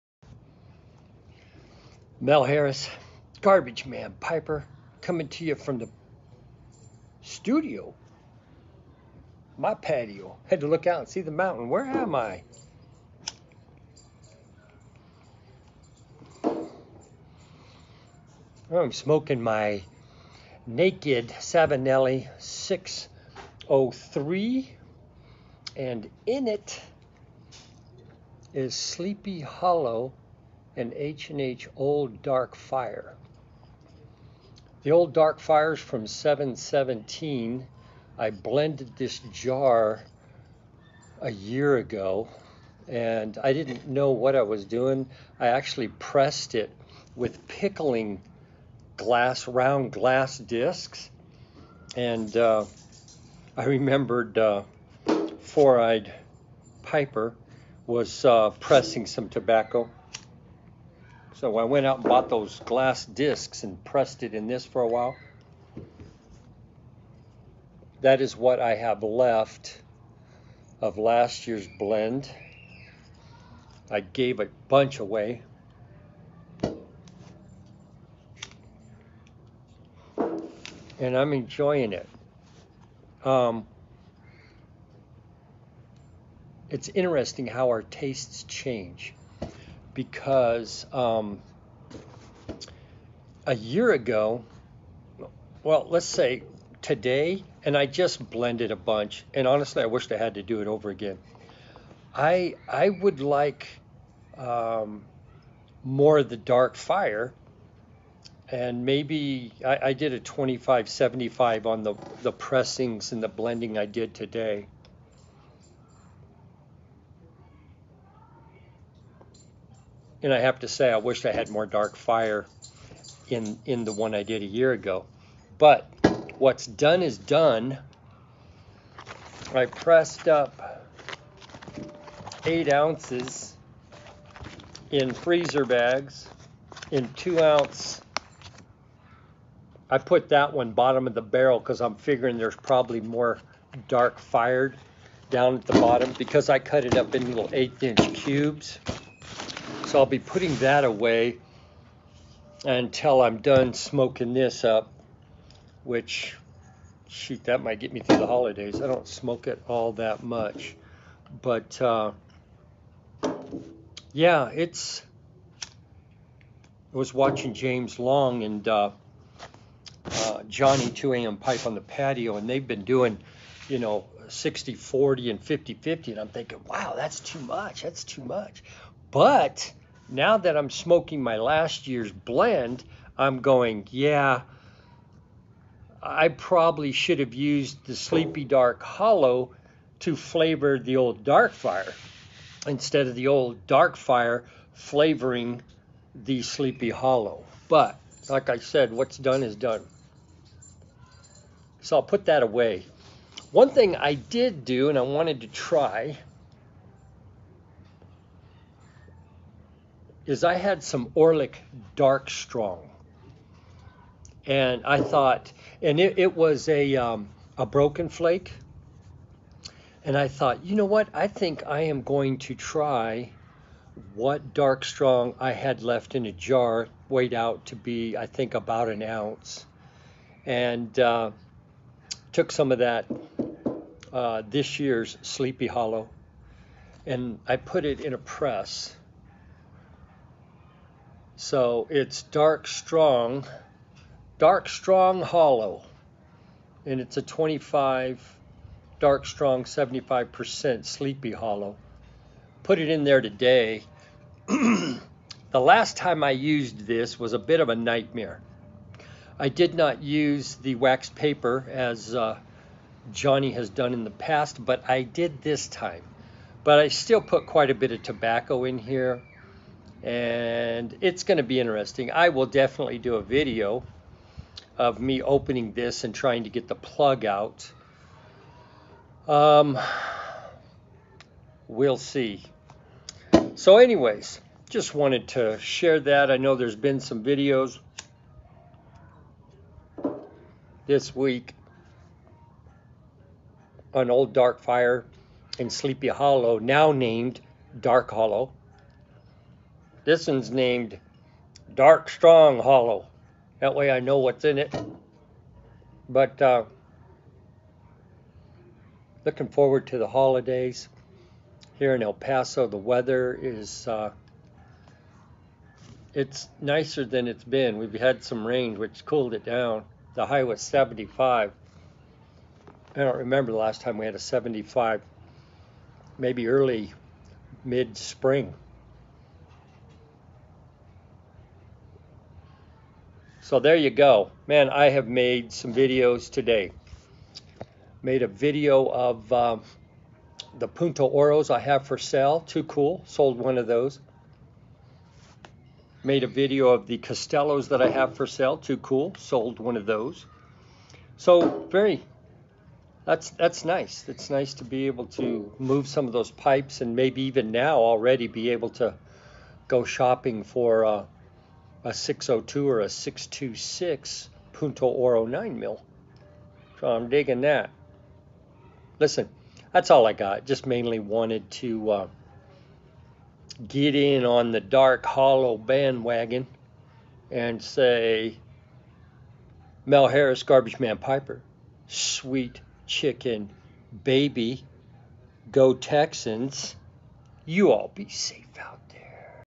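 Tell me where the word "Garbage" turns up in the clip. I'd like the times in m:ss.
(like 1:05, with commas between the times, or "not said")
0:03, 6:20.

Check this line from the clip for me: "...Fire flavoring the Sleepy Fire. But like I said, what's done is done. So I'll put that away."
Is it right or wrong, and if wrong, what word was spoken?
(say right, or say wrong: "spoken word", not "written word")
wrong: "Hollow", not "Fire".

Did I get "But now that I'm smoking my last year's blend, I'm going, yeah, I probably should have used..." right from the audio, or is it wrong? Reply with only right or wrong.
right.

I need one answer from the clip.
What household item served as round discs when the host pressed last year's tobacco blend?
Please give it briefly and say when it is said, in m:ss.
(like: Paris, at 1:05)
Pickling glass, at 0:47.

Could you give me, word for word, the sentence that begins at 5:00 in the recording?
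This one's named Dark Strong Hollow.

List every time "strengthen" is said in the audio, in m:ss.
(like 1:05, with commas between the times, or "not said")
not said.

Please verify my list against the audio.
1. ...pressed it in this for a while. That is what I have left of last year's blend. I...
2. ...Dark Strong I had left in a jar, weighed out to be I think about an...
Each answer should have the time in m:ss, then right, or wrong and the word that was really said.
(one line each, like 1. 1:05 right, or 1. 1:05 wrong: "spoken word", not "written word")
1. 1:03 right
2. 3:44 right.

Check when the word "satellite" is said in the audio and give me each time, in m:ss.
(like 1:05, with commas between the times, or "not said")
not said.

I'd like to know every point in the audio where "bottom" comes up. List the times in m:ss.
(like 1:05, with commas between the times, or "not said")
2:20, 2:25.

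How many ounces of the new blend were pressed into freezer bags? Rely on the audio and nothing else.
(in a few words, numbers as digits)
8.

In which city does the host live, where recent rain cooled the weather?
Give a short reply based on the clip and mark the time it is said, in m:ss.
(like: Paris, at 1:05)
El Paso, at 5:12.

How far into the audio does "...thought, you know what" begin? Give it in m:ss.
3:40.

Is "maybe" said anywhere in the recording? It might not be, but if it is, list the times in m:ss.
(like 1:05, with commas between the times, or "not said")
1:48, 5:26, 5:56.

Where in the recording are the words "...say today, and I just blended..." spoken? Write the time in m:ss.
1:36.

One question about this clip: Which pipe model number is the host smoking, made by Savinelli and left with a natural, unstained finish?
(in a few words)
603.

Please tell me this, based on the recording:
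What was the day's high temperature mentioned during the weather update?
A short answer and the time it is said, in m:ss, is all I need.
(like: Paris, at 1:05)
75, at 5:20.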